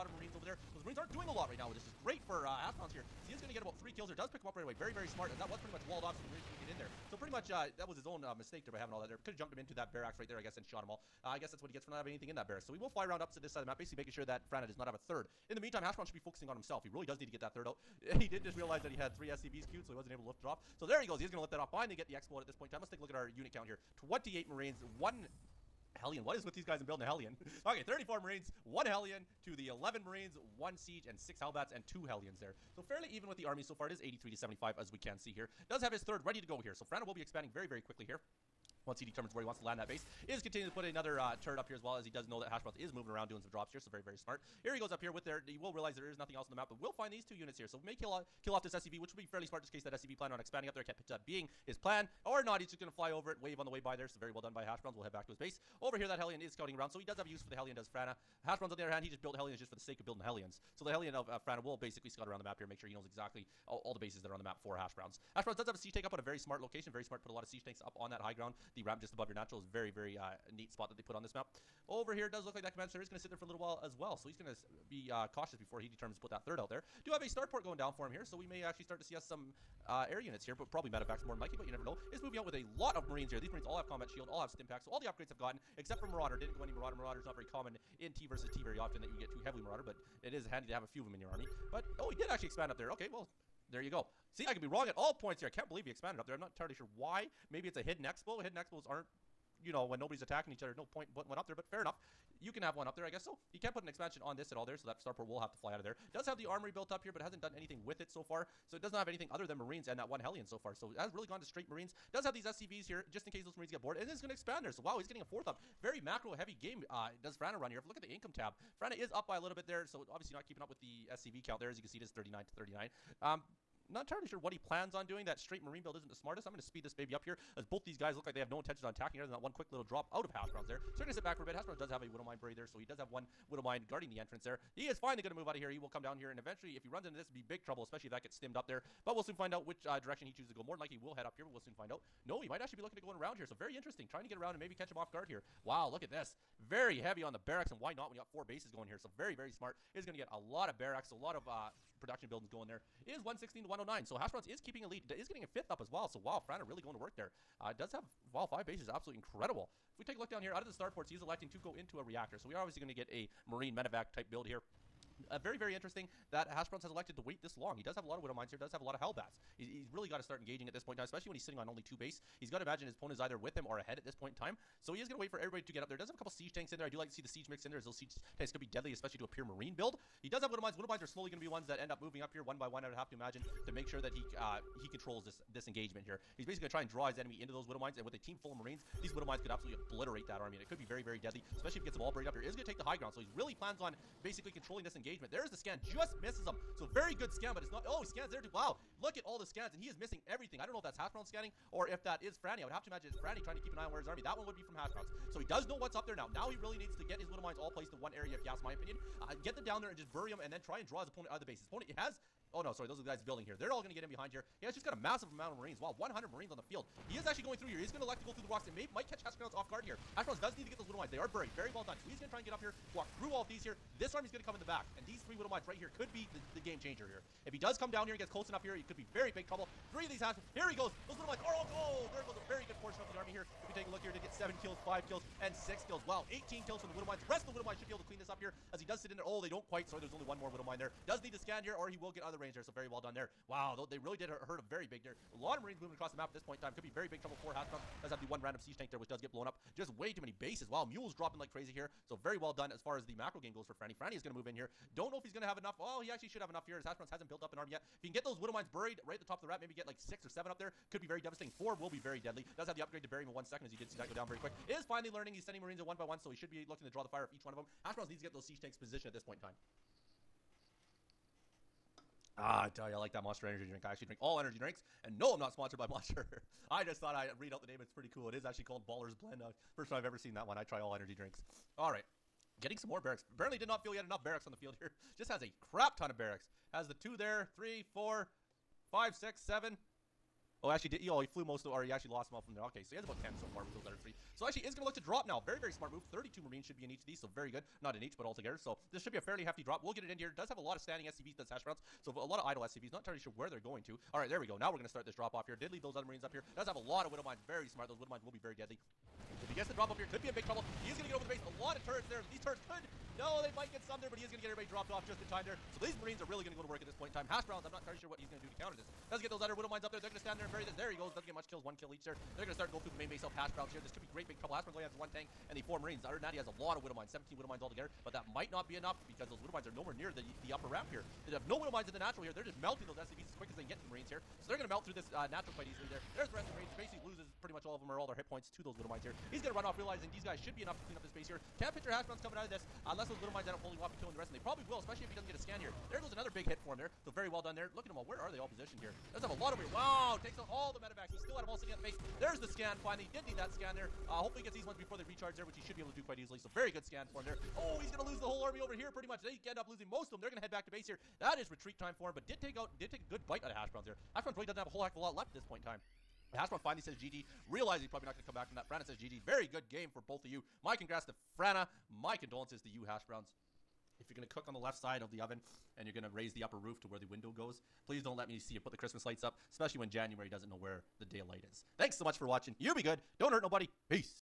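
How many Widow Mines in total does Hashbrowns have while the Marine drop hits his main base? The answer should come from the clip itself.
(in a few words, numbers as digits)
17.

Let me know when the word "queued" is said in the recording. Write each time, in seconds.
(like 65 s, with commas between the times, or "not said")
19 s.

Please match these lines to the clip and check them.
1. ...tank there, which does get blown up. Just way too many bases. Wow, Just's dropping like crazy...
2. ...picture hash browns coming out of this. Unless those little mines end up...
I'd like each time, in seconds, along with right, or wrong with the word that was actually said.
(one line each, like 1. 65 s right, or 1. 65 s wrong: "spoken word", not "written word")
1. 248 s wrong: "Mule", not "Just"
2. 341 s right.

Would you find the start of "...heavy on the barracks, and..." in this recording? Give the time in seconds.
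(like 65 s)
146 s.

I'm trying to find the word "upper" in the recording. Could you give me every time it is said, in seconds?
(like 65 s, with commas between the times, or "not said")
330 s, 376 s.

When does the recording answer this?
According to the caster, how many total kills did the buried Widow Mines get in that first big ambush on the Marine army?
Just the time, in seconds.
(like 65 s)
236 s.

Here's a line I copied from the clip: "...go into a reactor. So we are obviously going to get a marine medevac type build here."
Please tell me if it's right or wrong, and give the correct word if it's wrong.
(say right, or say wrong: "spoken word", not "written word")
right.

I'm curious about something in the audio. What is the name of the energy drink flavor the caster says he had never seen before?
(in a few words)
Ballers Blend.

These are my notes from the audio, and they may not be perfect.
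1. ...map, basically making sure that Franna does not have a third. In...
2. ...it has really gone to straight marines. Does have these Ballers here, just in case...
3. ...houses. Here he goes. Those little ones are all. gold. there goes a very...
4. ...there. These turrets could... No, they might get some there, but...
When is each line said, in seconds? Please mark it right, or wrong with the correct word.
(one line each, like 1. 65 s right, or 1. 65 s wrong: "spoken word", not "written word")
1. 13 s right
2. 110 s wrong: "SCVs", not "Ballers"
3. 230 s right
4. 312 s right.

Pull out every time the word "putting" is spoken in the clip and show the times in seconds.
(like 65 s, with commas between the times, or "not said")
101 s.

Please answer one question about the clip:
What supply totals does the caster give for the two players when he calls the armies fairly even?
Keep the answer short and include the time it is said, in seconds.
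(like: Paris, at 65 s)
83 to 75, at 34 s.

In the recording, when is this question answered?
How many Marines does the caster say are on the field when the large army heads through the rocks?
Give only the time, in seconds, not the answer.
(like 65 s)
215 s.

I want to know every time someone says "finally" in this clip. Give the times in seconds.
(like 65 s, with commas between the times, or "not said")
21 s, 134 s, 264 s, 352 s, 366 s.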